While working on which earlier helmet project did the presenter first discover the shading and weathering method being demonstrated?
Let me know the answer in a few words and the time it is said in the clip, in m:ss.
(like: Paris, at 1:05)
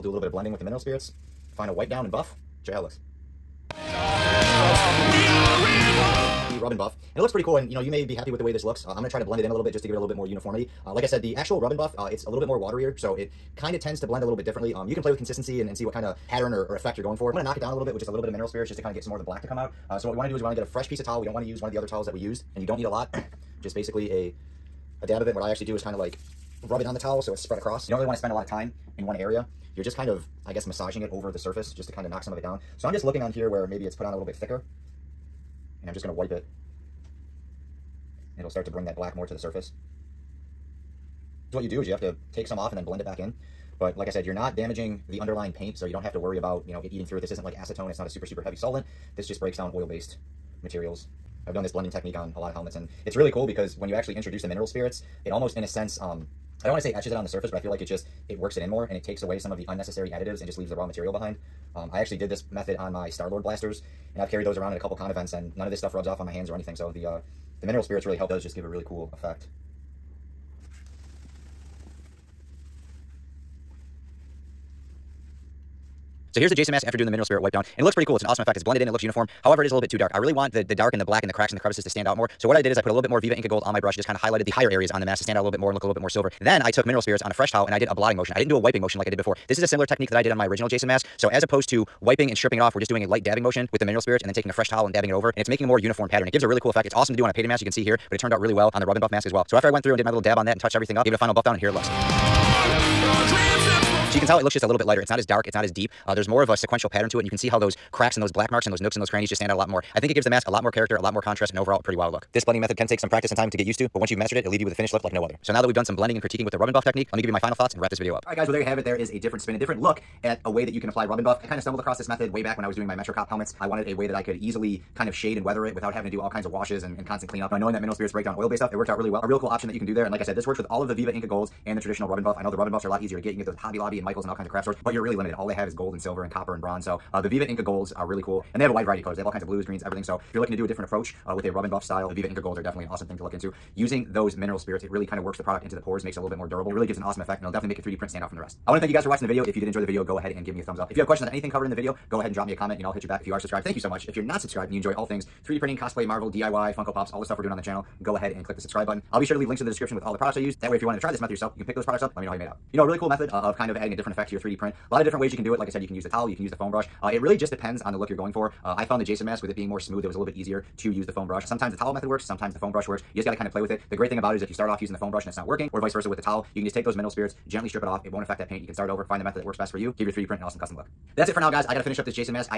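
MetroCop helmets, at 2:02.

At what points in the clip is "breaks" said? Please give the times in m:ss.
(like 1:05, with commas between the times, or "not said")
0:49, 2:08.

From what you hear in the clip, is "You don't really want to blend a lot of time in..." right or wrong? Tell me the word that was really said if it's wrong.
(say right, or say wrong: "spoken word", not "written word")
wrong: "spend", not "blend".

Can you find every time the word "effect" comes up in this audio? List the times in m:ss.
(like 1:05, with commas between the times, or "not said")
0:16, 1:09, 1:18, 1:36, 2:27, 2:44.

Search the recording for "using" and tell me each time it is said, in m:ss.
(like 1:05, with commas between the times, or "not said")
2:23, 2:54.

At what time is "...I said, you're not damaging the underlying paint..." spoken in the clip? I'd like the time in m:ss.
0:44.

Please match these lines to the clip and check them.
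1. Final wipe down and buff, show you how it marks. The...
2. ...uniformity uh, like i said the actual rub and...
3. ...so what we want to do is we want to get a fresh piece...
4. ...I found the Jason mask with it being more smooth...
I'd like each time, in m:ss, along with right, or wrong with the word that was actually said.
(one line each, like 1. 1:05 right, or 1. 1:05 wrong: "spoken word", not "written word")
1. 0:01 wrong: "looks", not "marks"
2. 0:10 right
3. 0:19 right
4. 2:48 right.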